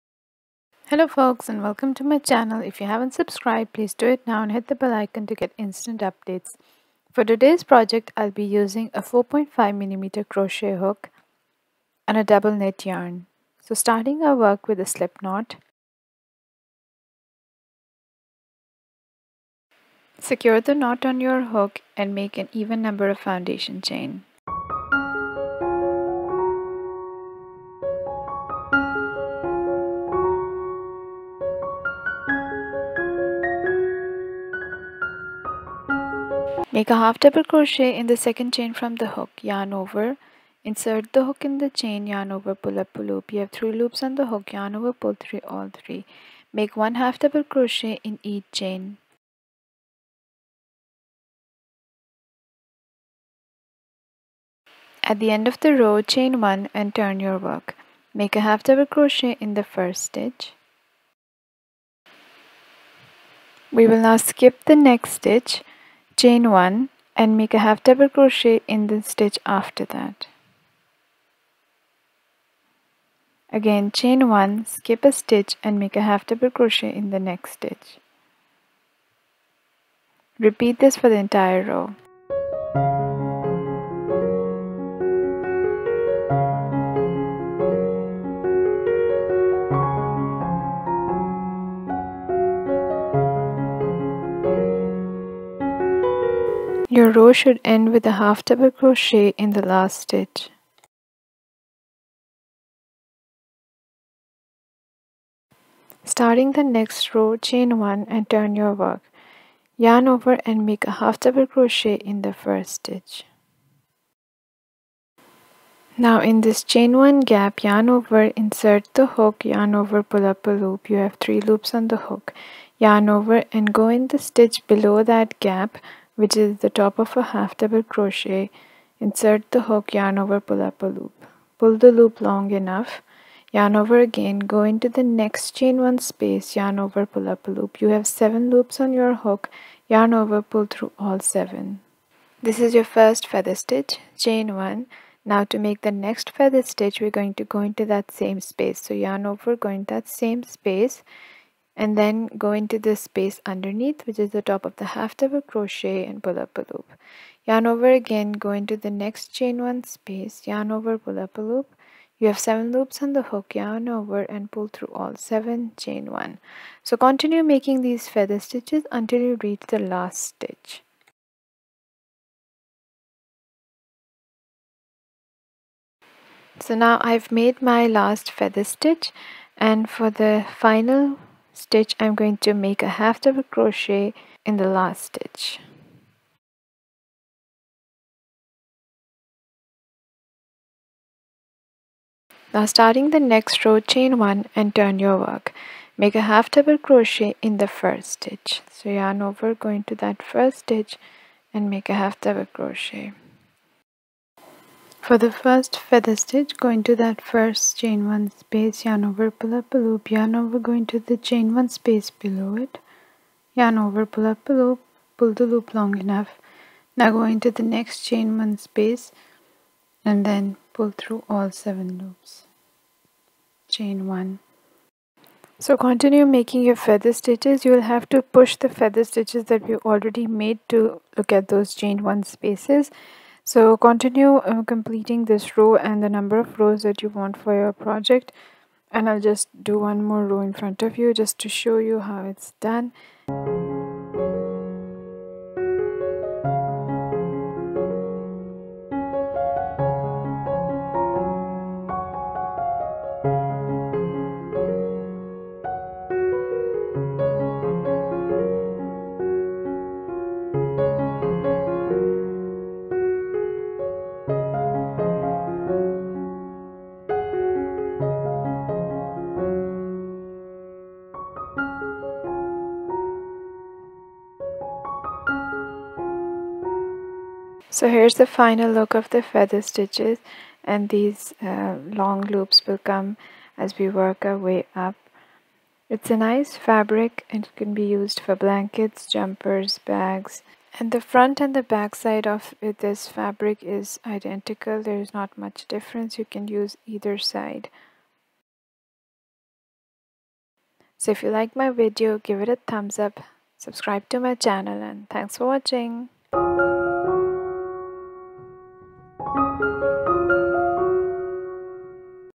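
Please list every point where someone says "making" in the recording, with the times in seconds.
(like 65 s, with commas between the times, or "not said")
167 s, 226 s.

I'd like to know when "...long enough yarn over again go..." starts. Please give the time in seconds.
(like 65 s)
132 s.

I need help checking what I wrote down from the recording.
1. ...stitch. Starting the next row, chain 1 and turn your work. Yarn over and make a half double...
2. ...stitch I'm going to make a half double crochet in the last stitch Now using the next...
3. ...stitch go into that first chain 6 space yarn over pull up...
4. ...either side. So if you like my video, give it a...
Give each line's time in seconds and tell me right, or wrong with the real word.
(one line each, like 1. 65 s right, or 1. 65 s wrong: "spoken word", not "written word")
1. 100 s right
2. 181 s wrong: "starting", not "using"
3. 206 s wrong: "1", not "6"
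4. 296 s right.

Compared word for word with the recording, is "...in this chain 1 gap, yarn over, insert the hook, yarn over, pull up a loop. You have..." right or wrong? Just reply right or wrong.
right.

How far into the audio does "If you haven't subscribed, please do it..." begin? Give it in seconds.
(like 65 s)
2 s.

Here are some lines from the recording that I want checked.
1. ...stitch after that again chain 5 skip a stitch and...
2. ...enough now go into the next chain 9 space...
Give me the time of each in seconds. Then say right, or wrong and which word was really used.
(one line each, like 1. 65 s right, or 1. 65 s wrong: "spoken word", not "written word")
1. 69 s wrong: "1", not "5"
2. 215 s wrong: "1", not "9".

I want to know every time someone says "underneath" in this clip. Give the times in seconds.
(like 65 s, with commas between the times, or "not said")
153 s.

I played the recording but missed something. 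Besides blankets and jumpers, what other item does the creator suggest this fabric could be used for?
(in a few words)
bags.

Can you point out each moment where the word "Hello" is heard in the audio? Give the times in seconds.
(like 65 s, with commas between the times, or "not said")
0 s.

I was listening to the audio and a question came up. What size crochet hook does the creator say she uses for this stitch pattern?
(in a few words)
4.5mm.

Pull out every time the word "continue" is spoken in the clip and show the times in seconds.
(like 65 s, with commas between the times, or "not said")
166 s, 225 s, 233 s.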